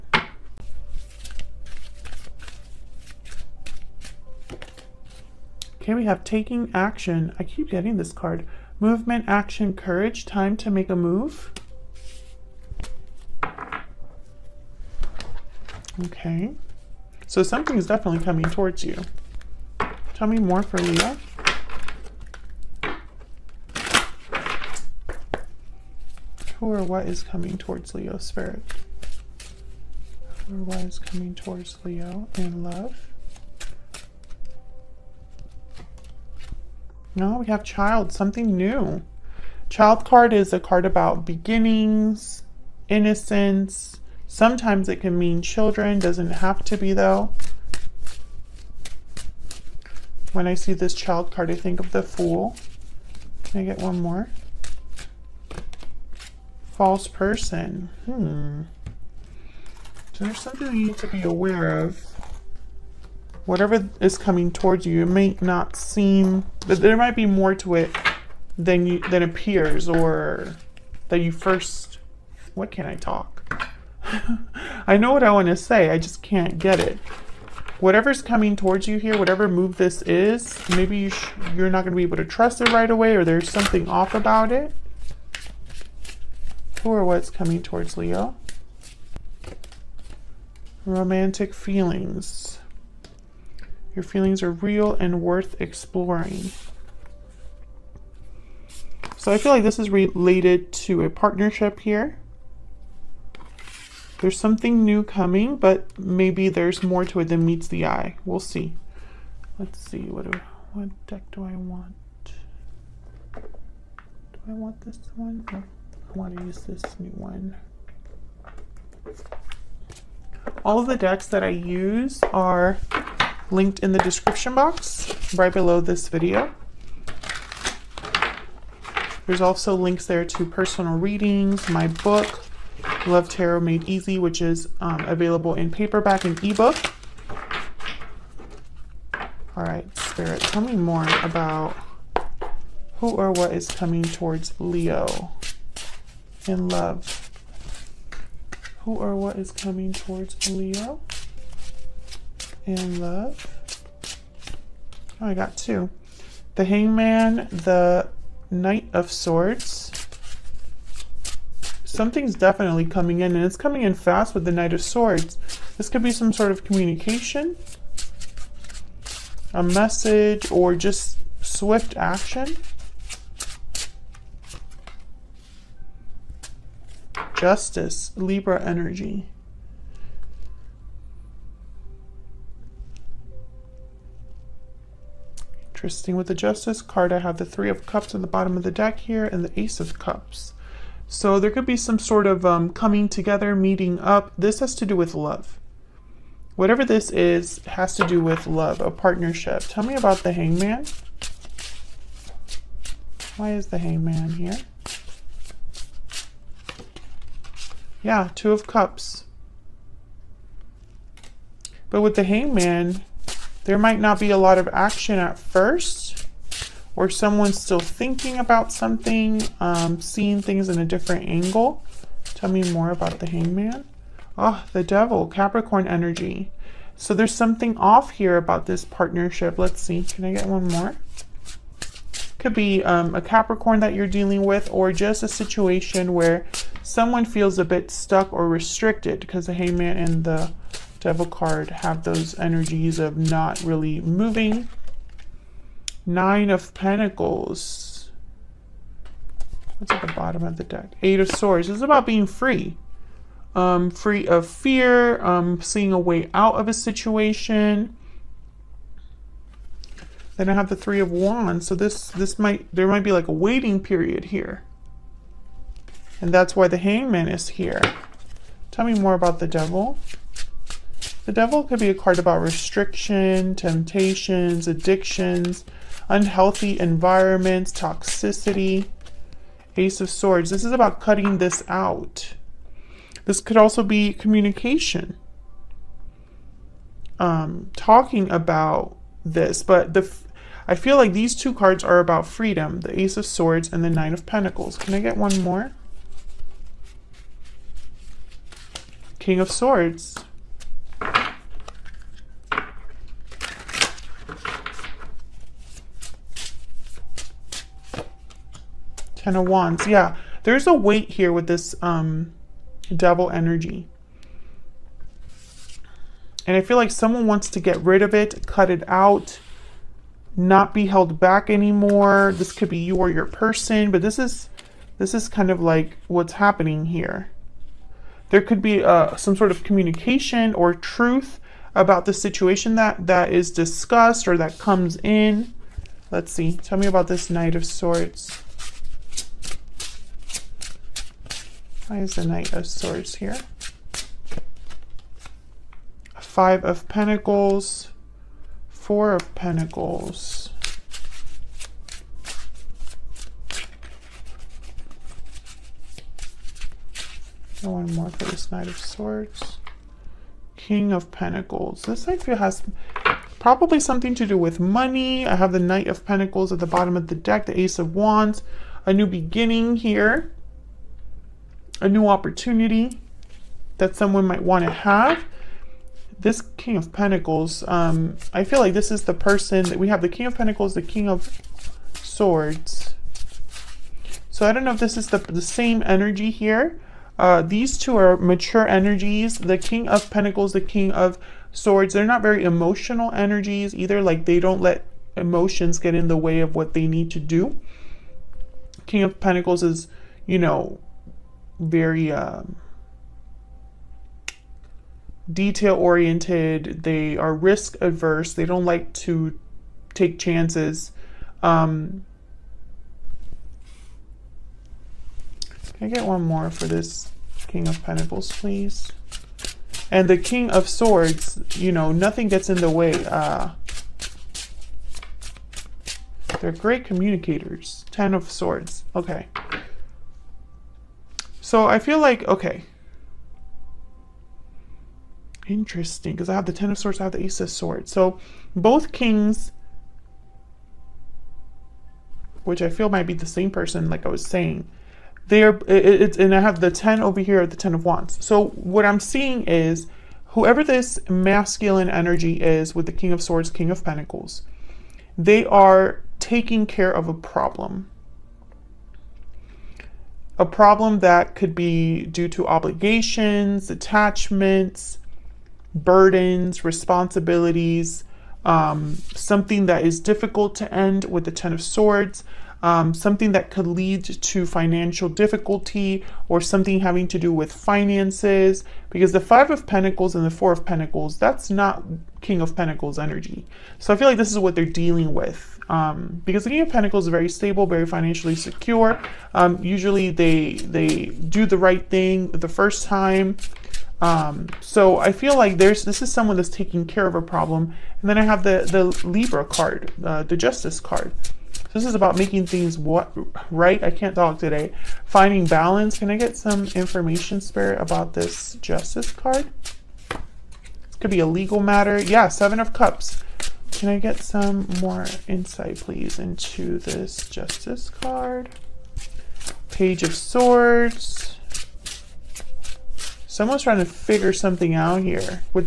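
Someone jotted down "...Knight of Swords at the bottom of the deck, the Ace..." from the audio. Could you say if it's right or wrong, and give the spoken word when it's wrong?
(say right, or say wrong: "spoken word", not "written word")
wrong: "Pentacles", not "Swords".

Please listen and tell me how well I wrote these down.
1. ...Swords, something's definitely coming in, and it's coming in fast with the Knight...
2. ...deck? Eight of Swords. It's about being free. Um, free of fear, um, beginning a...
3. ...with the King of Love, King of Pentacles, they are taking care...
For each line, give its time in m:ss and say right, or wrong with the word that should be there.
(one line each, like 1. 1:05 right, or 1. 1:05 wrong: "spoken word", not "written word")
1. 2:39 right
2. 4:10 wrong: "seeing", not "beginning"
3. 7:32 wrong: "Swords", not "Love".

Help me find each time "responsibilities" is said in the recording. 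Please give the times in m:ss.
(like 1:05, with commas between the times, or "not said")
7:46.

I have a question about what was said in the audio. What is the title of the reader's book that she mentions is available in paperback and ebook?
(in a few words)
Love Tarot Made Easy.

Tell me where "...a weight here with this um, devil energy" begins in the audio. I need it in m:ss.
5:10.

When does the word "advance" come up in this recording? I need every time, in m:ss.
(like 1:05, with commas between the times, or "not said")
not said.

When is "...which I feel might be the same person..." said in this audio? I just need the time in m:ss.
7:22.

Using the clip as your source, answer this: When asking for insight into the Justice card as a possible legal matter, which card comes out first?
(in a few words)
Seven of Cups.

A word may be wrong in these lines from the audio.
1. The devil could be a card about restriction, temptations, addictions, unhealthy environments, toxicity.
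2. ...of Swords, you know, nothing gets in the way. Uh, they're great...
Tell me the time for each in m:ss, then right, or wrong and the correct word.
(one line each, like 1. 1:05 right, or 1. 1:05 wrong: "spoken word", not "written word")
1. 4:31 right
2. 7:00 right.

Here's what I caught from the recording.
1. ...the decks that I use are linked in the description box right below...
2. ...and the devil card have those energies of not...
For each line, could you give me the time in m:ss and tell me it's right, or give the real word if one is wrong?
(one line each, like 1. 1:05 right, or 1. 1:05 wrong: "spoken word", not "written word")
1. 2:00 right
2. 3:59 right.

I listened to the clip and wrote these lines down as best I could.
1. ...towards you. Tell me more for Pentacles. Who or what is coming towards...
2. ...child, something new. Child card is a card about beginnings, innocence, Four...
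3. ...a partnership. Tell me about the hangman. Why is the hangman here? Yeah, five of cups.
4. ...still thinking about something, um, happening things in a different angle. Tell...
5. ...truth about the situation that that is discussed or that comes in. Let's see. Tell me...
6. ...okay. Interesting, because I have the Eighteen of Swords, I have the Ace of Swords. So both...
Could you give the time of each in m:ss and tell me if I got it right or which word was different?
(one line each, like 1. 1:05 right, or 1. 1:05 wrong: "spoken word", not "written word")
1. 0:18 wrong: "Leo", not "Pentacles"
2. 0:37 wrong: "Sometimes", not "Four"
3. 3:18 wrong: "two", not "five"
4. 3:37 wrong: "seeing", not "happening"
5. 5:30 right
6. 7:12 wrong: "Ten", not "Eighteen".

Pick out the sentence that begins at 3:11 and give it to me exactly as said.
So there could be some sort of um, coming together, meeting up.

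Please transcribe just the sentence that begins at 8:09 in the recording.
Um, usually they they do the right thing the first time.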